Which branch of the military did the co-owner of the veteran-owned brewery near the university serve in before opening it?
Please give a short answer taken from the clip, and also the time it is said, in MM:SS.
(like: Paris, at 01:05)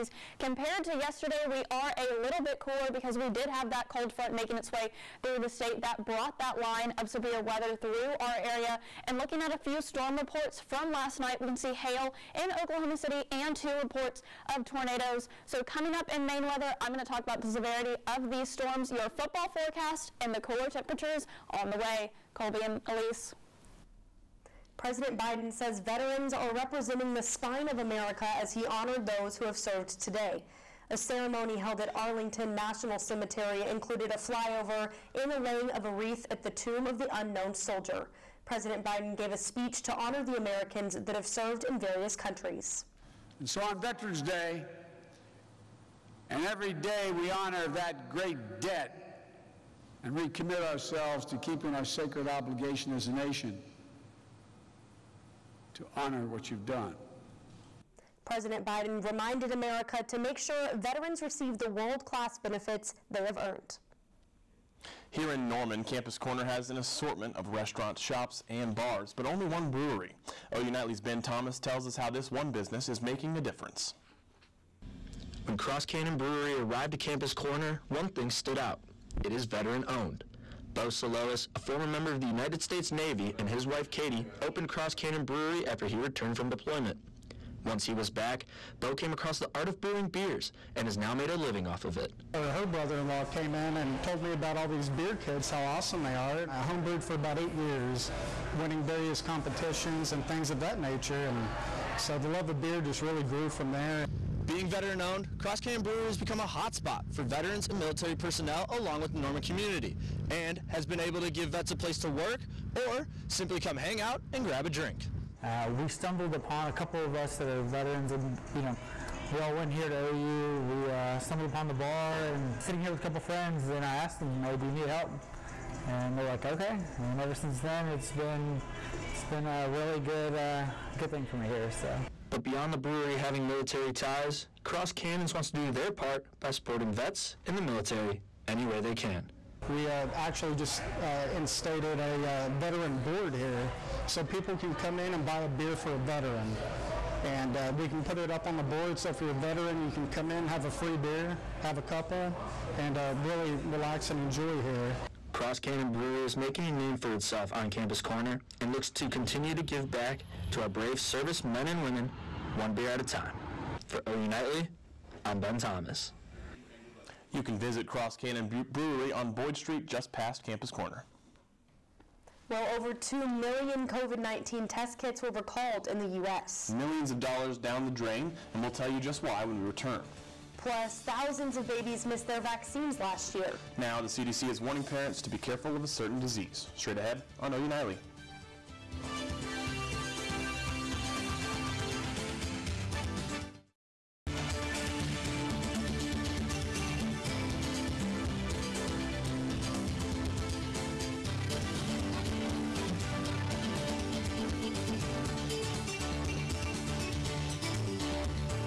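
Navy, at 01:22.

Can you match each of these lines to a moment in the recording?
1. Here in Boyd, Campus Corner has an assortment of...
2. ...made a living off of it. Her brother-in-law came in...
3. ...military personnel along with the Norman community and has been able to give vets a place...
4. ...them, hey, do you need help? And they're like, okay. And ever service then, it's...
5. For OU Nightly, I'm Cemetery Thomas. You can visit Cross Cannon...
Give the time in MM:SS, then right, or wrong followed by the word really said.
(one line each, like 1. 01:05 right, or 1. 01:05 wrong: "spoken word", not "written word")
1. 01:05 wrong: "Norman", not "Boyd"
2. 01:31 right
3. 01:47 right
4. 02:04 wrong: "since", not "service"
5. 02:43 wrong: "Ben", not "Cemetery".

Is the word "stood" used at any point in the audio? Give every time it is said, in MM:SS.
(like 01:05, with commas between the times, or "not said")
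01:18.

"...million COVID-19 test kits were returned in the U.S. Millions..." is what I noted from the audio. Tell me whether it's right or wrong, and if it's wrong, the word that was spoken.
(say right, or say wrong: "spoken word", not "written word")
wrong: "recalled", not "returned".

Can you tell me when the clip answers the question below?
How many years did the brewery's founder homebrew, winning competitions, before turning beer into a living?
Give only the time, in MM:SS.
01:37.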